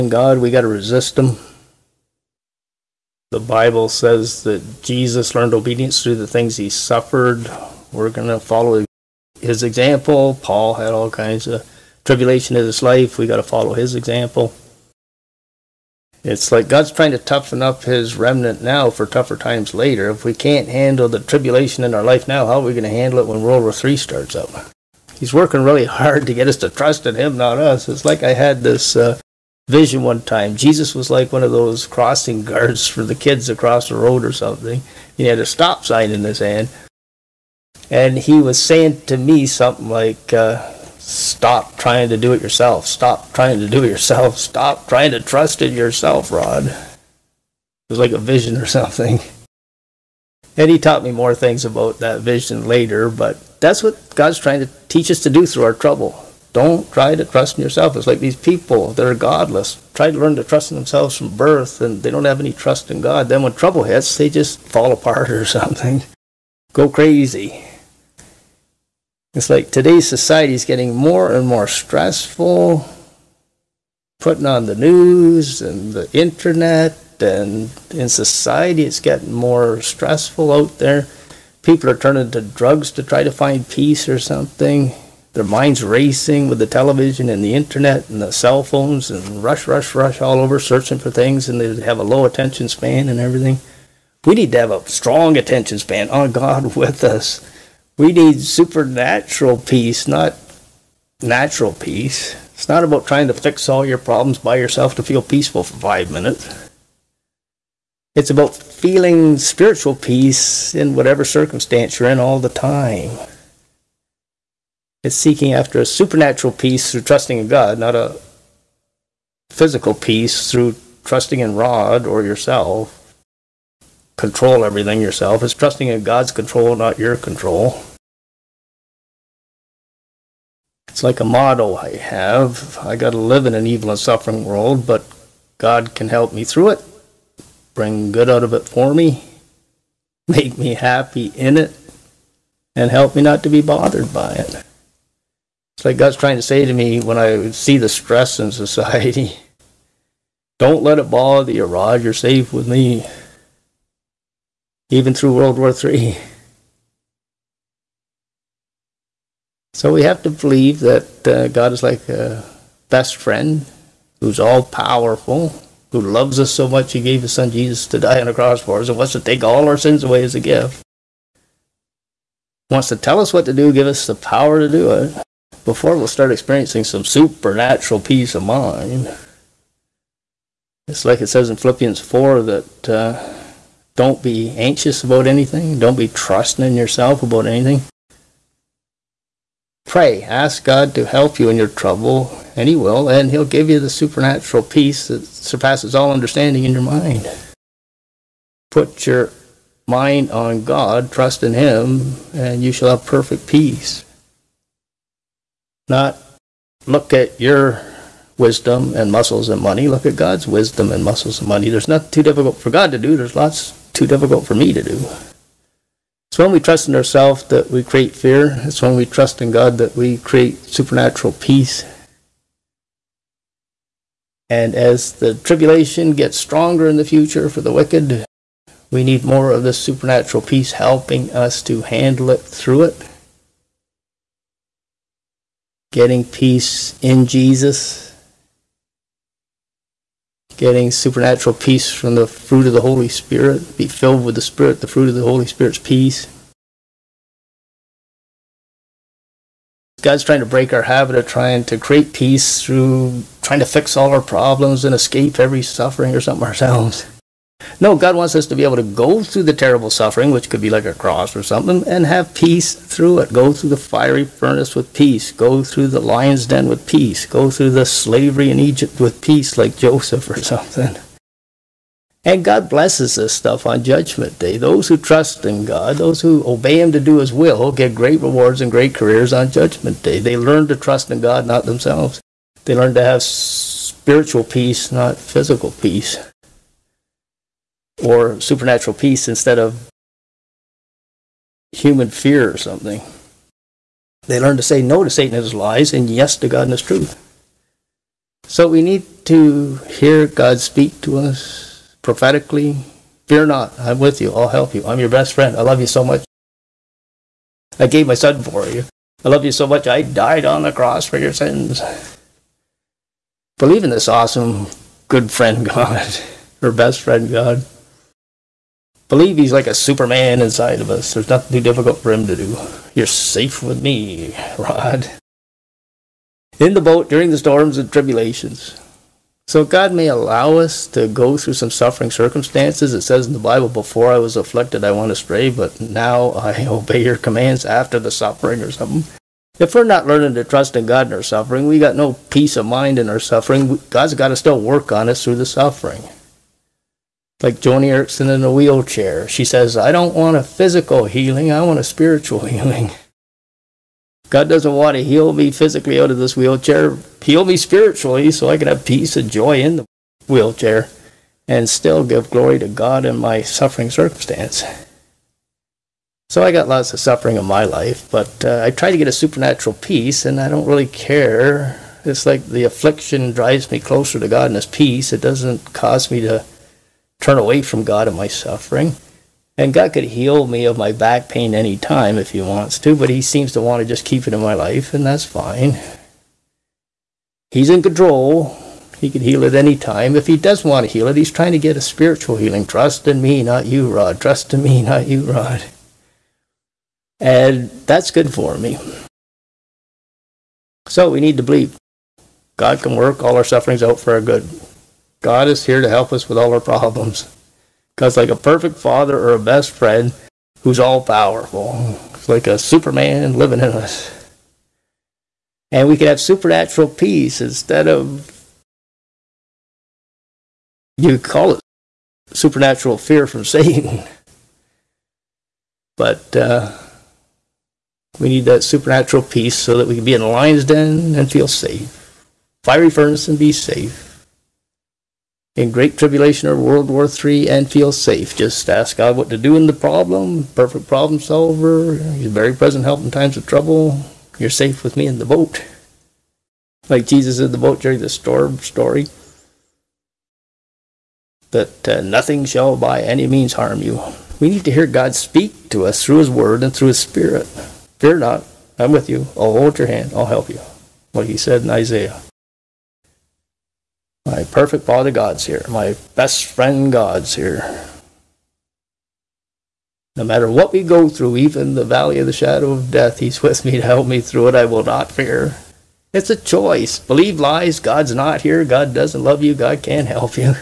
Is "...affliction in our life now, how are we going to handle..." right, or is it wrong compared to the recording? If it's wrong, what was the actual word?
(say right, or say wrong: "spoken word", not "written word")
wrong: "tribulation", not "affliction".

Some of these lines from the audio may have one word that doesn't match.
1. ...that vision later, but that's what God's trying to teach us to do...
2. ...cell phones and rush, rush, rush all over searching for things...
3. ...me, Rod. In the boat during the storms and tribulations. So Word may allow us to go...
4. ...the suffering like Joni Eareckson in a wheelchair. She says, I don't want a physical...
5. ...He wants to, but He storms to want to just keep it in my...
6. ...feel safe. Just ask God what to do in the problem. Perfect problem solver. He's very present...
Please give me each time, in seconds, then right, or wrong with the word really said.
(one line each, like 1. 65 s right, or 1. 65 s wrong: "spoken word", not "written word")
1. 51 s right
2. 88 s right
3. 323 s wrong: "God", not "Word"
4. 345 s right
5. 382 s wrong: "seems", not "storms"
6. 437 s right.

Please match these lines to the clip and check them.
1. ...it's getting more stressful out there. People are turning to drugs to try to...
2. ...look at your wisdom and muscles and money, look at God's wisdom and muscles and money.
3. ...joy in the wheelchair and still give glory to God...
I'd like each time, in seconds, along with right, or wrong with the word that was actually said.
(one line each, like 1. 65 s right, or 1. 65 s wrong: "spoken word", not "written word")
1. 78 s right
2. 206 s right
3. 359 s right.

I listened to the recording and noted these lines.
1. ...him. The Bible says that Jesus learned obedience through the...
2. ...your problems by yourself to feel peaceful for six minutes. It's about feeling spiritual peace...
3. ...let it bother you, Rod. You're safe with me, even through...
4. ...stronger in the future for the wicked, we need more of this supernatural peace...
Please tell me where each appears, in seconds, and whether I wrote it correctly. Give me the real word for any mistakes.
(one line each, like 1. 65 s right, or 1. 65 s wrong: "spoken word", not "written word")
1. 1 s right
2. 103 s wrong: "five", not "six"
3. 150 s right
4. 226 s right.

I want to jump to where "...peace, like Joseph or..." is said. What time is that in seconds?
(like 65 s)
269 s.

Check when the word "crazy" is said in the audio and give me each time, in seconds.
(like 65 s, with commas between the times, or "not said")
66 s.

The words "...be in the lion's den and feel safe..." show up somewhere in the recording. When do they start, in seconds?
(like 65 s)
430 s.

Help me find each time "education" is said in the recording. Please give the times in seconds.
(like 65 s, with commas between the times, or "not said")
not said.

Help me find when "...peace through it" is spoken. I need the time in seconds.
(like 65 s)
262 s.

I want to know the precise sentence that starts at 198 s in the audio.
Put your mind on God, trust in Him, and you shall have perfect peace.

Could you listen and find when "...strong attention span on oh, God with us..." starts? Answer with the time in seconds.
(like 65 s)
94 s.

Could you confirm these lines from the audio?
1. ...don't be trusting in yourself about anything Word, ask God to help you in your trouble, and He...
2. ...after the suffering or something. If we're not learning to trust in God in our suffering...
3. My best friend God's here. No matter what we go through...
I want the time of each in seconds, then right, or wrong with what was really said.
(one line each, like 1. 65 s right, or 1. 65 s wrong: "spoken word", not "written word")
1. 185 s wrong: "Pray", not "Word"
2. 337 s right
3. 465 s right.